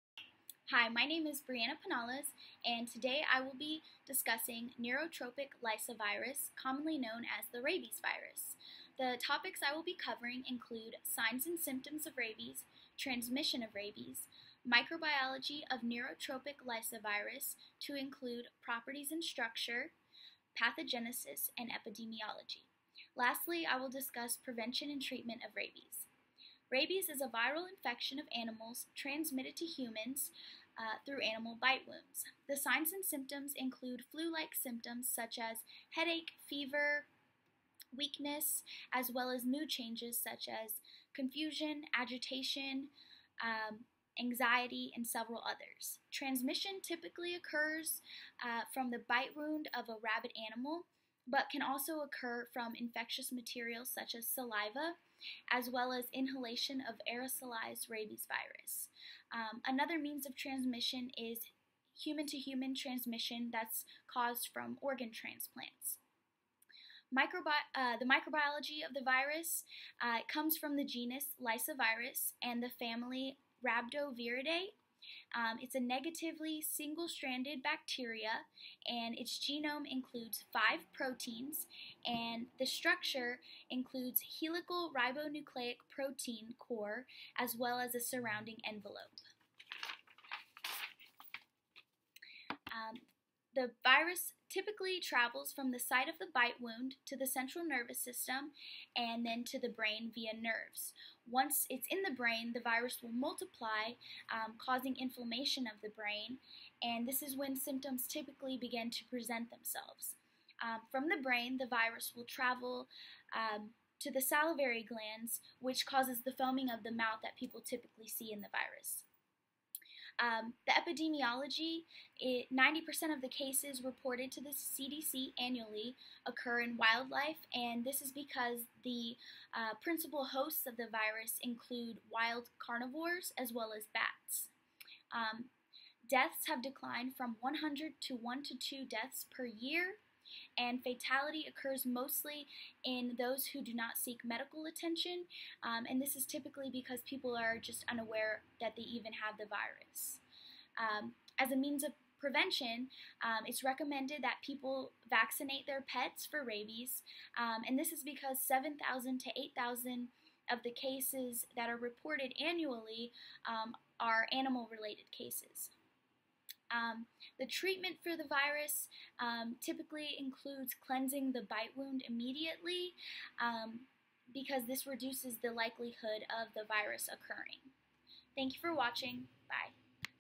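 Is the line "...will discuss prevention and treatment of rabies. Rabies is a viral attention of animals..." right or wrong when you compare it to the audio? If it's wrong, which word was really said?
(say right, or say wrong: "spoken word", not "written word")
wrong: "infection", not "attention".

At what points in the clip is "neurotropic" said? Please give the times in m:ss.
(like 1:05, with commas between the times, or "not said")
0:04, 0:15.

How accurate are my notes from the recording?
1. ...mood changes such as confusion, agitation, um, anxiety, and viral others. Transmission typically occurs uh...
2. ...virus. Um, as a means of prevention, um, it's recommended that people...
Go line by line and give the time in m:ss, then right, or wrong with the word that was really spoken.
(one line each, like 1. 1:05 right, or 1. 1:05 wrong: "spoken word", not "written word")
1. 0:39 wrong: "several", not "viral"
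2. 2:29 right.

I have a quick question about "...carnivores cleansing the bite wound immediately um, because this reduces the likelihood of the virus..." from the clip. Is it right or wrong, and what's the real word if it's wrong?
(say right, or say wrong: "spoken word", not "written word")
wrong: "includes", not "carnivores".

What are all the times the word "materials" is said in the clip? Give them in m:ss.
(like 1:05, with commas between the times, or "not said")
0:53.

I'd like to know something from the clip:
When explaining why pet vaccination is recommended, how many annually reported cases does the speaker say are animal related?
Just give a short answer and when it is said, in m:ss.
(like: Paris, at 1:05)
7,000 to 8,000, at 2:38.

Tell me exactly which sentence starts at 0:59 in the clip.
Um, another means of transmission is human to human transmission that's caused from organ transplants.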